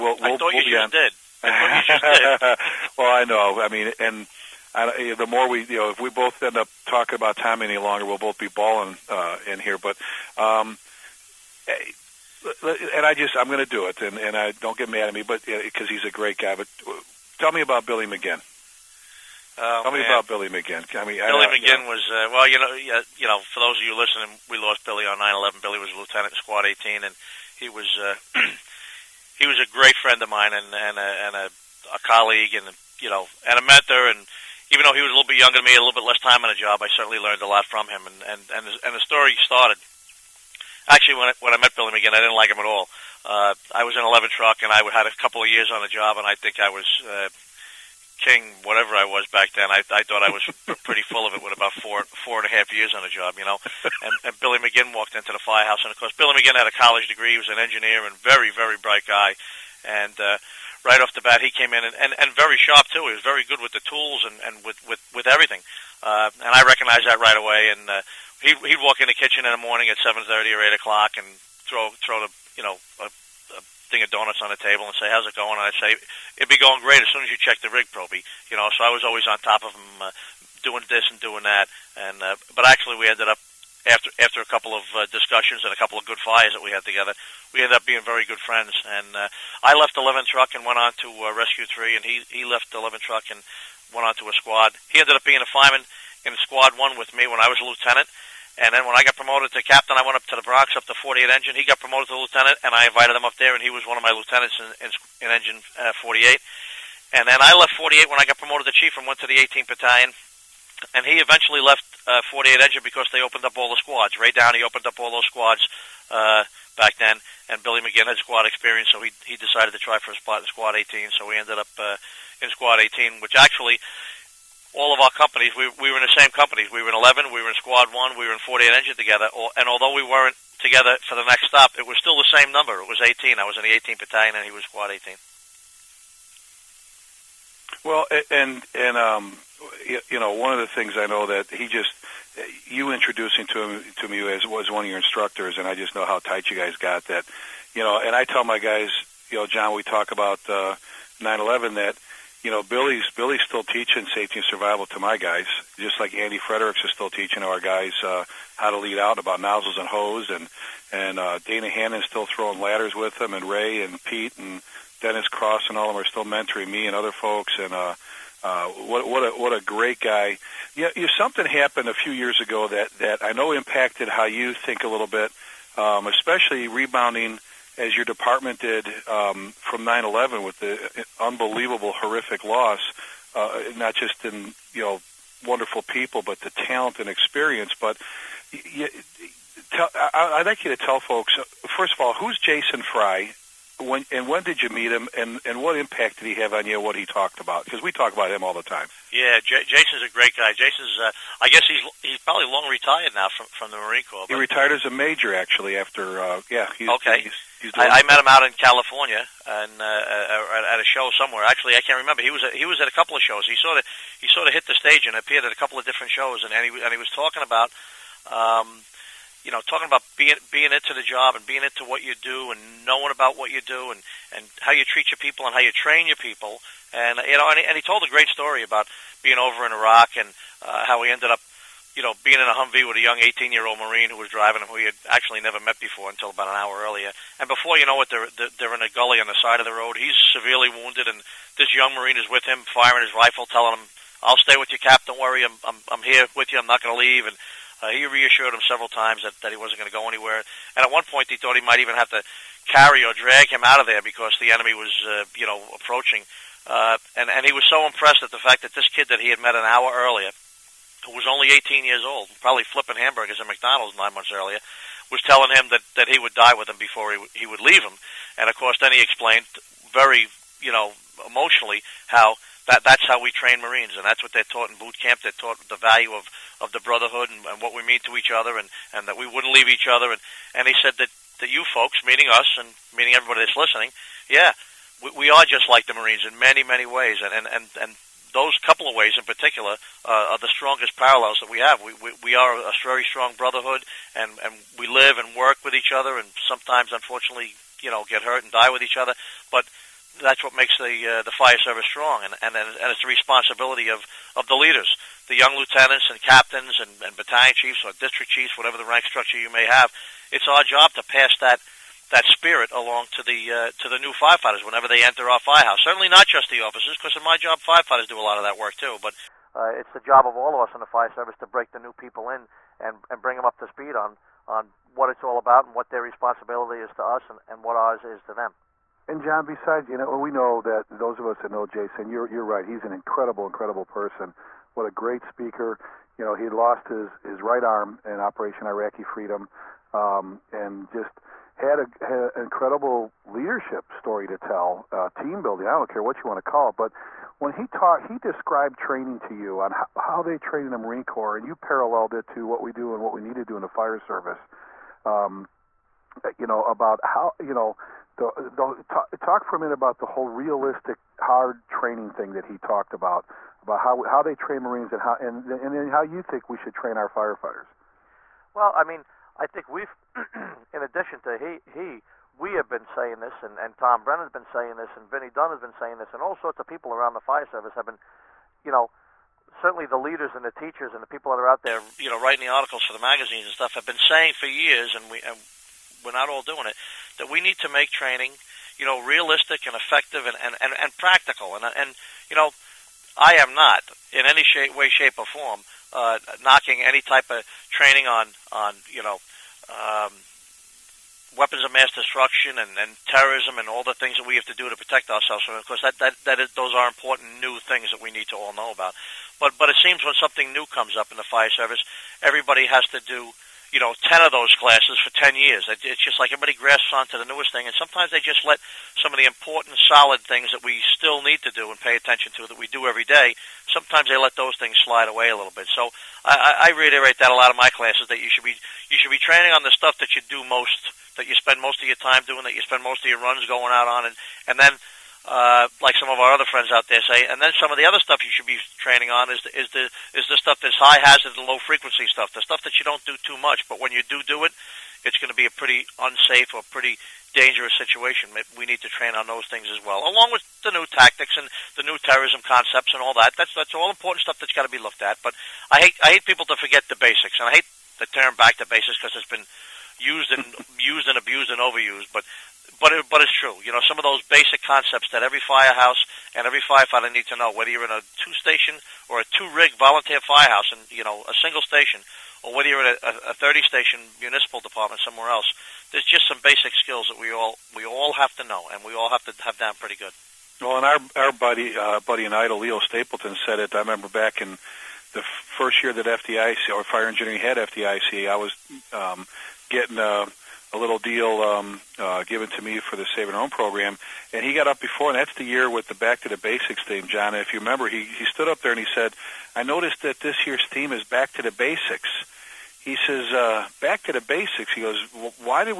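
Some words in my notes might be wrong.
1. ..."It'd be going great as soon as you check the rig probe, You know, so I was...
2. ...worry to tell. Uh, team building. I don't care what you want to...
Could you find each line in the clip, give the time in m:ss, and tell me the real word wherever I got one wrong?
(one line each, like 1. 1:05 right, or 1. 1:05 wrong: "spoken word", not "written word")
1. 1:16 right
2. 5:43 wrong: "story", not "worry".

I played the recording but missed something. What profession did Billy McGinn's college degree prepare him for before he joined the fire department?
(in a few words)
Engineer.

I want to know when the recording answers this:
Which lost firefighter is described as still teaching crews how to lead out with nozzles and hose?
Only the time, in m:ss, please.
2:36.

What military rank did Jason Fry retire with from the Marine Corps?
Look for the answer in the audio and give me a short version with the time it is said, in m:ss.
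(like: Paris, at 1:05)
Major, at 3:24.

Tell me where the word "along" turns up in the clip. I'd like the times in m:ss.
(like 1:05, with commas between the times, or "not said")
5:12, 7:30.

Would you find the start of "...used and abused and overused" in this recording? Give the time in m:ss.
7:40.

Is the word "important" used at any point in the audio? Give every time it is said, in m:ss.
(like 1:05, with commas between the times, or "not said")
6:46, 6:59, 7:33.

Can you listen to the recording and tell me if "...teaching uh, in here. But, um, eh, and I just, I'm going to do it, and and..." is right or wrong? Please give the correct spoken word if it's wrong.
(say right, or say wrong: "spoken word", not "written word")
wrong: "bawling", not "teaching".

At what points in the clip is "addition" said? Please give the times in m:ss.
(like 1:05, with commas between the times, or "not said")
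6:10.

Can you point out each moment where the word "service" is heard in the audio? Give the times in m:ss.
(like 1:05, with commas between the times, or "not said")
5:01, 5:21, 5:53, 6:17, 6:51.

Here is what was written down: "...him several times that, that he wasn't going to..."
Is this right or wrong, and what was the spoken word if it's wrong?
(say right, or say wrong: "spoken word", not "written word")
right.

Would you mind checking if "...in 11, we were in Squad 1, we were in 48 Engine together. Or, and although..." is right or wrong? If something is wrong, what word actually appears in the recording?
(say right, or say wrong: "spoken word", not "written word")
right.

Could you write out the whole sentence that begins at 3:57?
And before you know it, they're they're in a gully on the side of the road.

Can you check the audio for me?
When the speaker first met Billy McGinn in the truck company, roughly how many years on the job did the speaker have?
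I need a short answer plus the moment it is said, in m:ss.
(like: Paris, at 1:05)
4 and a half years, at 0:51.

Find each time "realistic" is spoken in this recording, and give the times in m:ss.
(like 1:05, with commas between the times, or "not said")
6:00, 6:29.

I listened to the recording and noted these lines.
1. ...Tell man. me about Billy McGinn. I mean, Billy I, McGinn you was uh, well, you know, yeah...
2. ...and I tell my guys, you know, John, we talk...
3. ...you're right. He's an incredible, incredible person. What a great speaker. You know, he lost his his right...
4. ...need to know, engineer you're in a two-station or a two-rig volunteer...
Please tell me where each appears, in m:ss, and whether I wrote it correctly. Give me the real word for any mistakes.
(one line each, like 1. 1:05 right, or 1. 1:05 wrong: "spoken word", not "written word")
1. 0:19 right
2. 2:28 right
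3. 5:32 right
4. 7:47 wrong: "whether", not "engineer".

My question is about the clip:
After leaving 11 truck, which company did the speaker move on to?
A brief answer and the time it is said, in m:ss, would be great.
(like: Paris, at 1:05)
Rescue 3, at 1:31.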